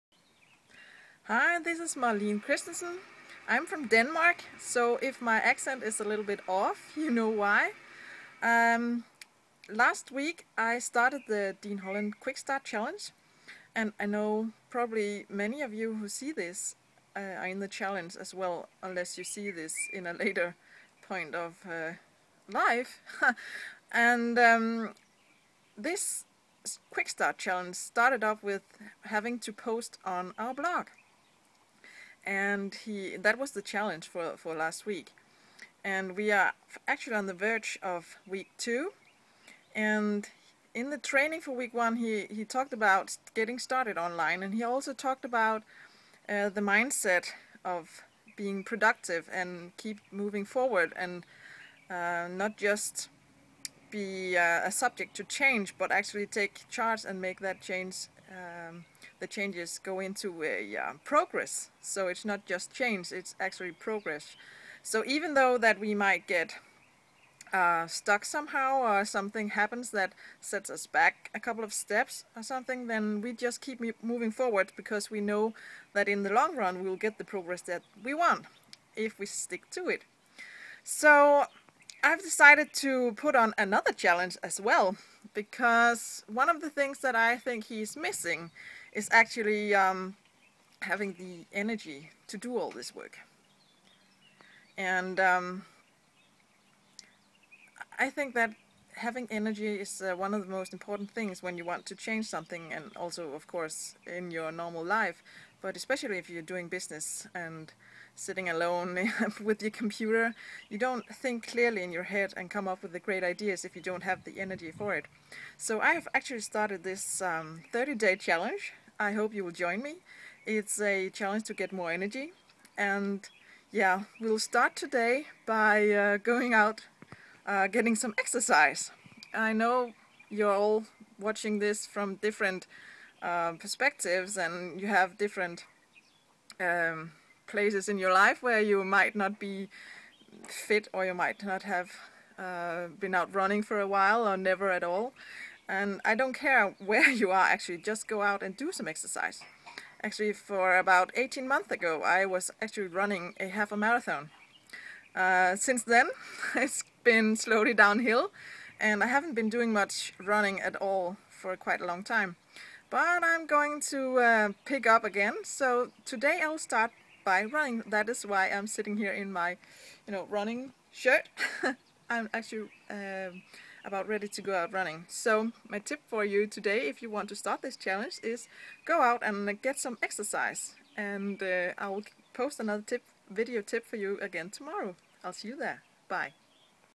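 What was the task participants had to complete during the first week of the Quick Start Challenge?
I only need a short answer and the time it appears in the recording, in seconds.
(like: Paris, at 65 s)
post on our blog, at 29 s.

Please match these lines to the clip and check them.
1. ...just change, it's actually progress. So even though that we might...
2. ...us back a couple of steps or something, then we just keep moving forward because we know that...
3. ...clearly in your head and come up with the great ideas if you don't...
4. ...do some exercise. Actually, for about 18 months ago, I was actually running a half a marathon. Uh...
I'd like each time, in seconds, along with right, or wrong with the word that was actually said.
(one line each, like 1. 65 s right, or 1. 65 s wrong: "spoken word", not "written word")
1. 62 s right
2. 70 s right
3. 111 s right
4. 148 s right.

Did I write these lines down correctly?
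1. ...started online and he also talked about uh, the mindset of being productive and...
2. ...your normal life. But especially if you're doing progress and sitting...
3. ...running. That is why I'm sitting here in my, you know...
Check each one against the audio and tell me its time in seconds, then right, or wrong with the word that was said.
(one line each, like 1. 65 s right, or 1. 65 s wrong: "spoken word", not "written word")
1. 43 s right
2. 104 s wrong: "business", not "progress"
3. 167 s right.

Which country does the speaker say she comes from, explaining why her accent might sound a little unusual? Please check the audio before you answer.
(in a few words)
Denmark.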